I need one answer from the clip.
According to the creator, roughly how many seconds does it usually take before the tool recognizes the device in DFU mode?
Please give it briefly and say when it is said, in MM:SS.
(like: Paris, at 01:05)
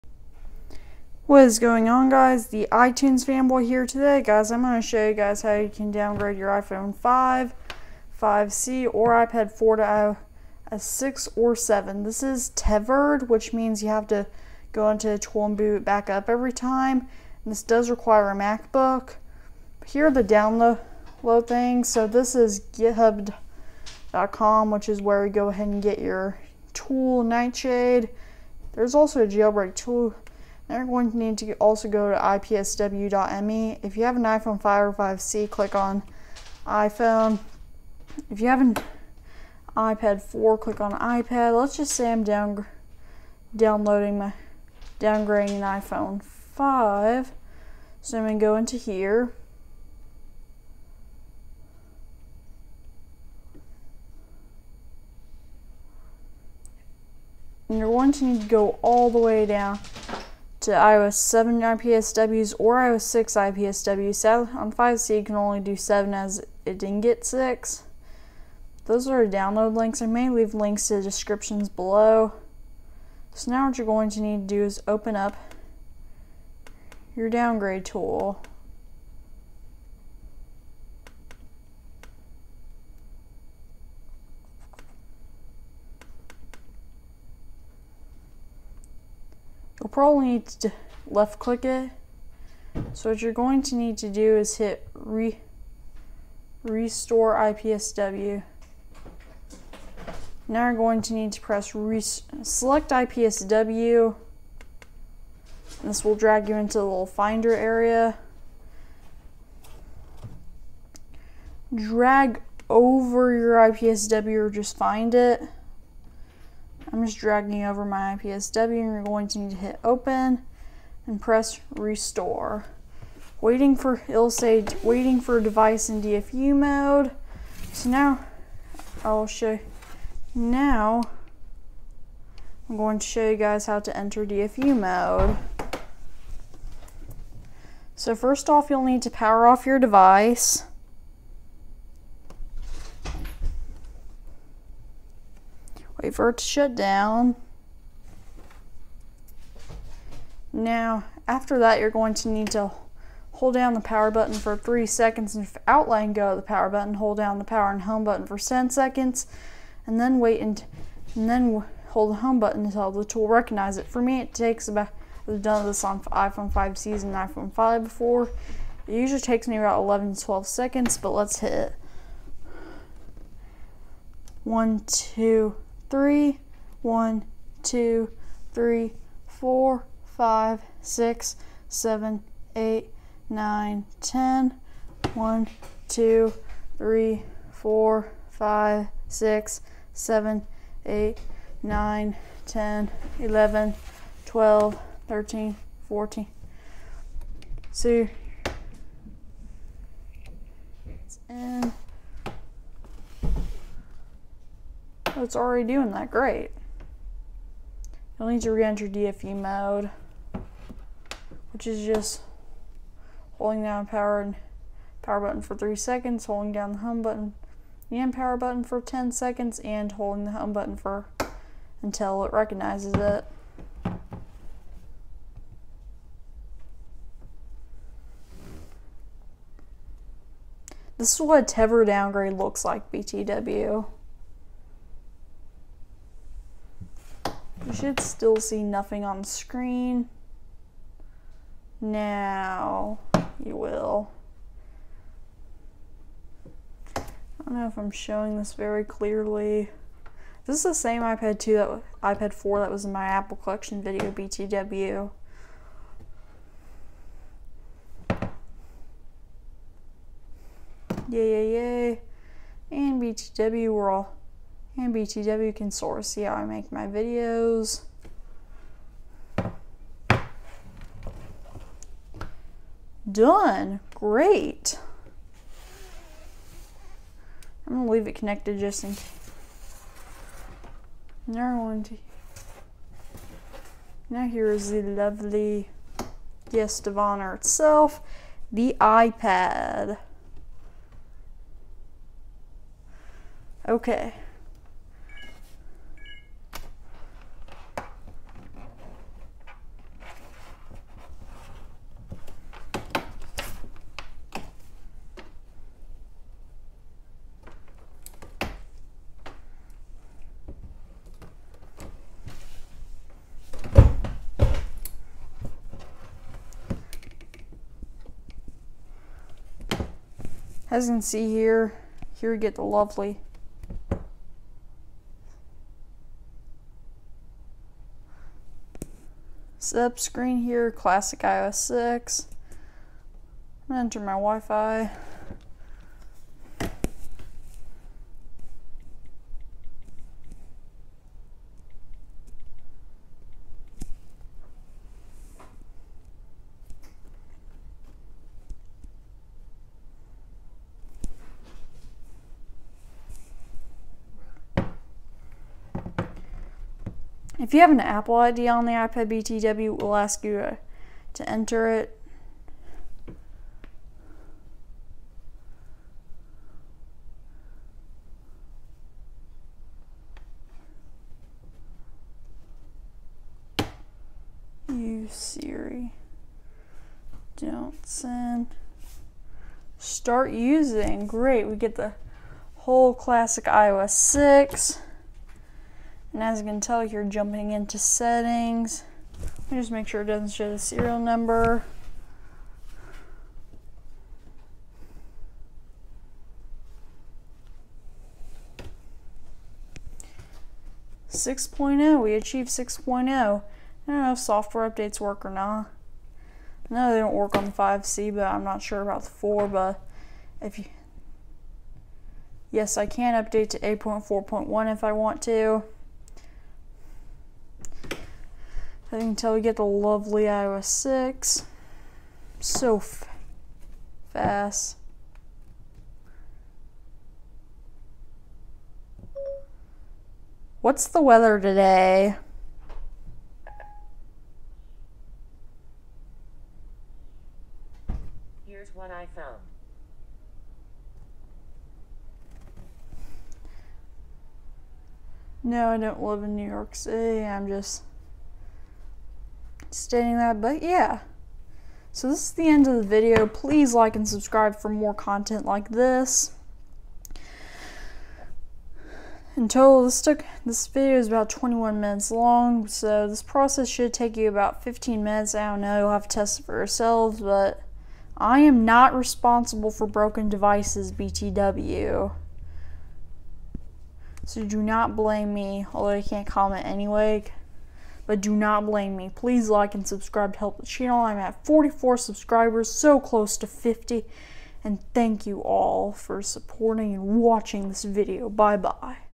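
11 to 12, at 02:49.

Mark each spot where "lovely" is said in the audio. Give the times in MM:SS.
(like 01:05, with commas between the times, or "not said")
04:44, 05:22, 06:59.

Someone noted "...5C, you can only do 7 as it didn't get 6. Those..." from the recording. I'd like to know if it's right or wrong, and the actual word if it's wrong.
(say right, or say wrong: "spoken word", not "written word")
right.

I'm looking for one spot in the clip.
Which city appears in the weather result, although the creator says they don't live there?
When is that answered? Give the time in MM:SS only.
07:26.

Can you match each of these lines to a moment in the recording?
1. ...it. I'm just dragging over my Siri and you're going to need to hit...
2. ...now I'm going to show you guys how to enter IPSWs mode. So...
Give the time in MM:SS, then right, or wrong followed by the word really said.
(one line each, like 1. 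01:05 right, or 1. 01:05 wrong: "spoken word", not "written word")
1. 01:55 wrong: "IPSW", not "Siri"
2. 02:10 wrong: "DFU", not "IPSWs".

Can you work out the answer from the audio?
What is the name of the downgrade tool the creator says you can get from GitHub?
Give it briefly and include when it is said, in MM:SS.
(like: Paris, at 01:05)
N1ghtshade, at 00:27.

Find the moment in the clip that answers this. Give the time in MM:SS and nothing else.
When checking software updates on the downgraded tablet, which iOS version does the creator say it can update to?
06:53.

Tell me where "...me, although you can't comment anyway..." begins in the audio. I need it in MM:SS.
07:55.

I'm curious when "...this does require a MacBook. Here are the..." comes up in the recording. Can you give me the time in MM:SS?
00:17.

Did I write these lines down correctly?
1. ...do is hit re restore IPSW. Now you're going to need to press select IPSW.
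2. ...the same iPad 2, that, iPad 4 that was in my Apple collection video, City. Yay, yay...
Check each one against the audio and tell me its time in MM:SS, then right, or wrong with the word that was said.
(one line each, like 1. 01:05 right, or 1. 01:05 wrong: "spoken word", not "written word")
1. 01:34 right
2. 04:10 wrong: "BTW", not "City".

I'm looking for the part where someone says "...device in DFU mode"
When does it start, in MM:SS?
02:05.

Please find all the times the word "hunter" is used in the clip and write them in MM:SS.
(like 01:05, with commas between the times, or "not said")
not said.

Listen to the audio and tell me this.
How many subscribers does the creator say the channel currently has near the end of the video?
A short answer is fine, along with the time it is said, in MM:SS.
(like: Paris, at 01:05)
44, at 08:01.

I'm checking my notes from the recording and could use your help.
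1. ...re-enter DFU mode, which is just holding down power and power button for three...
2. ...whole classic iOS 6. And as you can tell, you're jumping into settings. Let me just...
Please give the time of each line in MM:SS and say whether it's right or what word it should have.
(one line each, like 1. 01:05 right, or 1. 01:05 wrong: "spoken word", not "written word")
1. 03:28 right
2. 06:22 right.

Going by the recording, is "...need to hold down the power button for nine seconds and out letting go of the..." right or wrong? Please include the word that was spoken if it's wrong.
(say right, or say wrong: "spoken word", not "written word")
wrong: "three", not "nine".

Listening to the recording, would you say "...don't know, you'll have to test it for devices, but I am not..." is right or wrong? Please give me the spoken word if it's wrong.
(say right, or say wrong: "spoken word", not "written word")
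wrong: "yourselves", not "devices".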